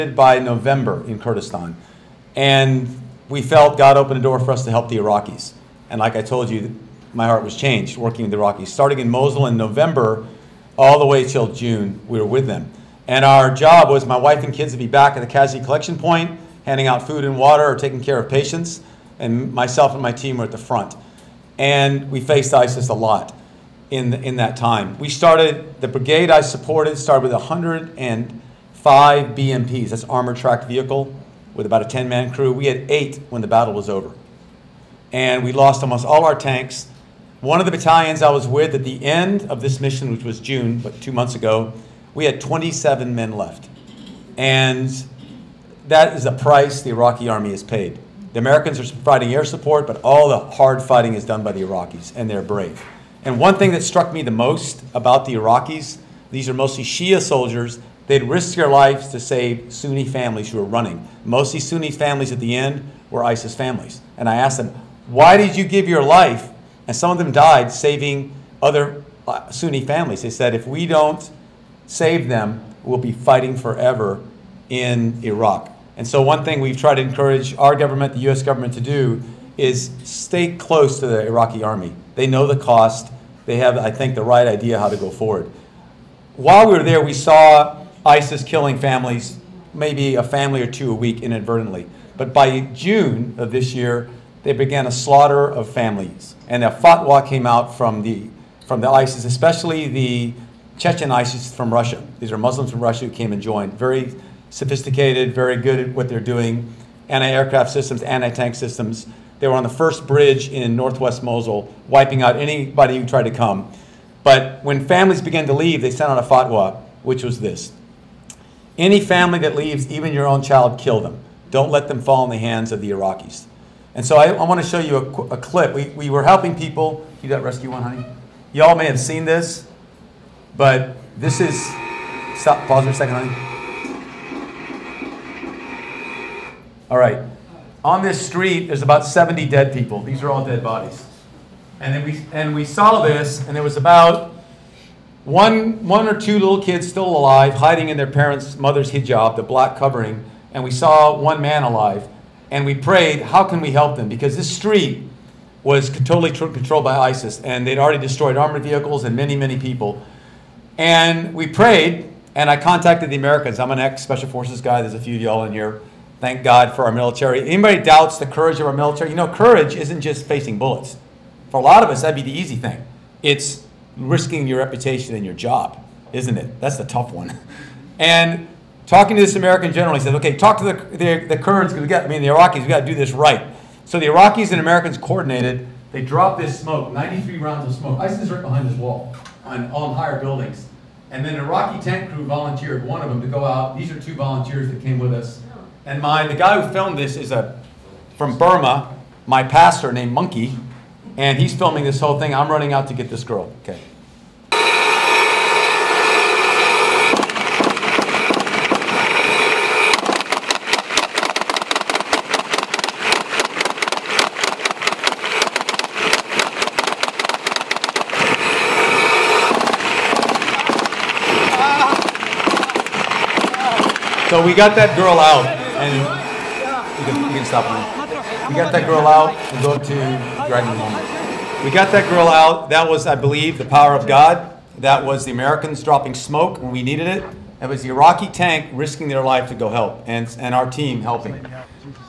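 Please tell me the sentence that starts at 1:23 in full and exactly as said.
They have, I think, the right idea how to go forward.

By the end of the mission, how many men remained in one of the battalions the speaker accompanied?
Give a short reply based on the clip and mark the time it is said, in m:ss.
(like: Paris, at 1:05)
27, at 0:42.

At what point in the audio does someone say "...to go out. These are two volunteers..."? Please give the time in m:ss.
3:13.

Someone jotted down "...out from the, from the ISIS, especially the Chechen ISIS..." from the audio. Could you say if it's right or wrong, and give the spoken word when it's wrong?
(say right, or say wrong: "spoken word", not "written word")
right.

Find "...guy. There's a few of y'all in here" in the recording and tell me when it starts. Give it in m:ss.
2:44.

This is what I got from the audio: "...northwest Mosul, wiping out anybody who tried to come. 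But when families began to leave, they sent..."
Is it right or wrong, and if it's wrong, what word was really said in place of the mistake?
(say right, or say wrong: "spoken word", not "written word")
right.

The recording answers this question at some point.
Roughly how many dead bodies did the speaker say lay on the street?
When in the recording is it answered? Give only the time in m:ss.
2:18.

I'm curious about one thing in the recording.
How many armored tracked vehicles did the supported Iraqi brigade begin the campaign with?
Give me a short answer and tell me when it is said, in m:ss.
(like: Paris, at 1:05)
105, at 0:27.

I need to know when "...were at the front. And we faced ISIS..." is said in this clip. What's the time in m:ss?
0:20.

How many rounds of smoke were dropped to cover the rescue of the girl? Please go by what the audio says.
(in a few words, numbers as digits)
93.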